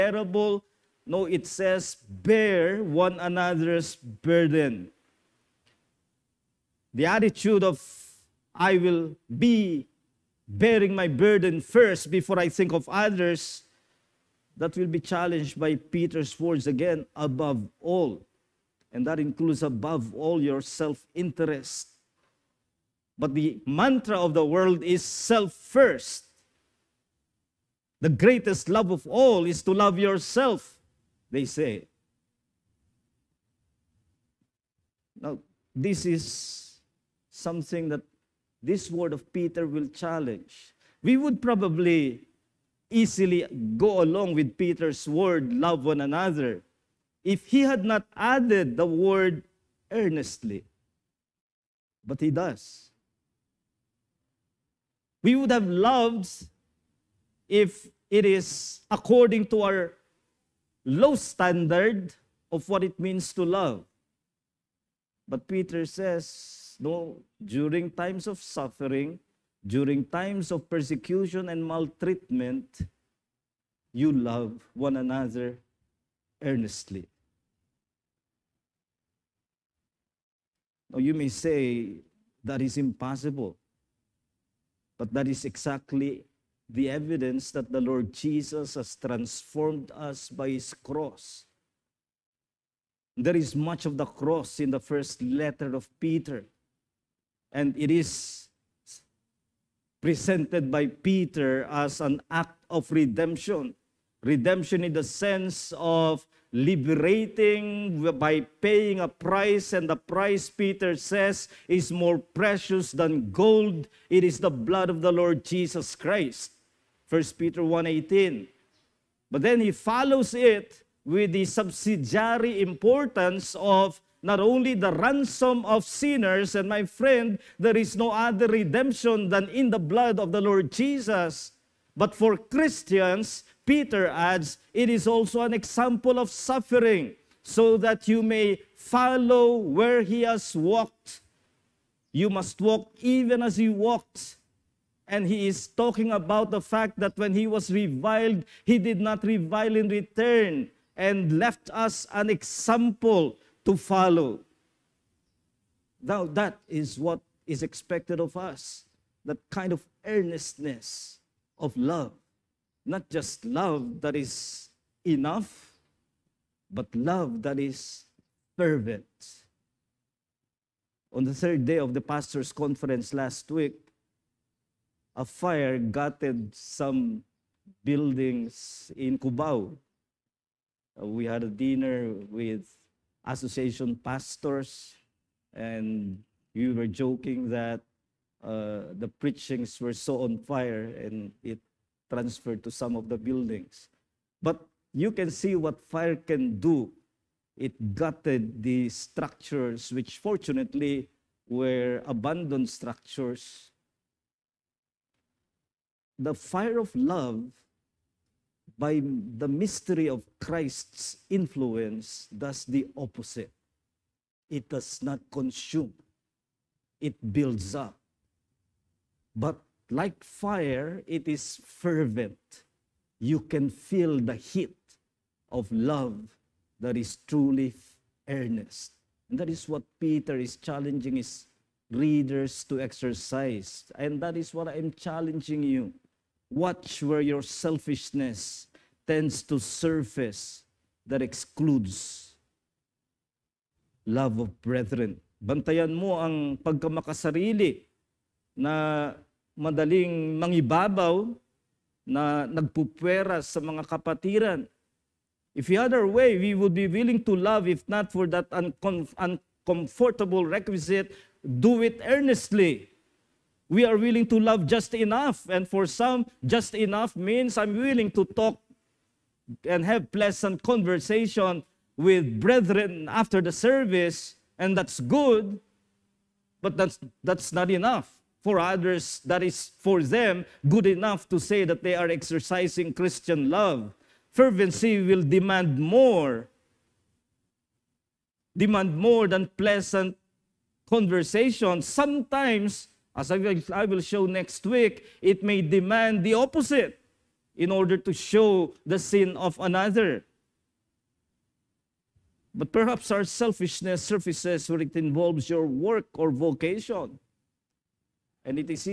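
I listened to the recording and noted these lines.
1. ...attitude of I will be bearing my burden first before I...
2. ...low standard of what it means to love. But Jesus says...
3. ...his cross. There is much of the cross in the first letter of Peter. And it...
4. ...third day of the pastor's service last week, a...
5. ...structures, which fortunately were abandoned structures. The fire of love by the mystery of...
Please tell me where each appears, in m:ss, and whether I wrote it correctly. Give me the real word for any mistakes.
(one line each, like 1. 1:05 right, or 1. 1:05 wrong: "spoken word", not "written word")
1. 0:07 right
2. 1:00 wrong: "Peter", not "Jesus"
3. 1:30 right
4. 2:51 wrong: "conference", not "service"
5. 3:18 right.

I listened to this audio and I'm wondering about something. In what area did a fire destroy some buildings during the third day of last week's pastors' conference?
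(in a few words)
Cubao.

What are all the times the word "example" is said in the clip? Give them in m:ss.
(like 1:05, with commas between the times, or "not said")
2:15, 2:32.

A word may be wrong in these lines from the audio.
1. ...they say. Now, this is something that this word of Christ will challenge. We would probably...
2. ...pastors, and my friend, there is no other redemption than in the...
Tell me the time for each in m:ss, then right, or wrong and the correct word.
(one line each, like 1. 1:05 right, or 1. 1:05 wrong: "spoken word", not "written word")
1. 0:31 wrong: "Peter", not "Christ"
2. 2:05 wrong: "sinners", not "pastors".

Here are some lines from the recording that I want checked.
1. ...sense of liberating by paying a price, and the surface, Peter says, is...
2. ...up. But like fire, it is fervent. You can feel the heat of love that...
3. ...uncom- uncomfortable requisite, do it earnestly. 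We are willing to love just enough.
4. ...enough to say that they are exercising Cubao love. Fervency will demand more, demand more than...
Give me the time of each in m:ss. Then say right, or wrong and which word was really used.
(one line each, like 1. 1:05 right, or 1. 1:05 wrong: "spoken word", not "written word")
1. 1:45 wrong: "price", not "surface"
2. 3:37 right
3. 4:18 right
4. 4:40 wrong: "Christian", not "Cubao".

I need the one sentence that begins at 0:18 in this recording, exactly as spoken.
And that includes above all your self interest.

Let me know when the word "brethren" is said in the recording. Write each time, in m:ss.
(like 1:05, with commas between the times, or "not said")
4:04, 4:32.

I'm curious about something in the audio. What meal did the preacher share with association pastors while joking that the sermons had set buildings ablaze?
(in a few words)
dinner.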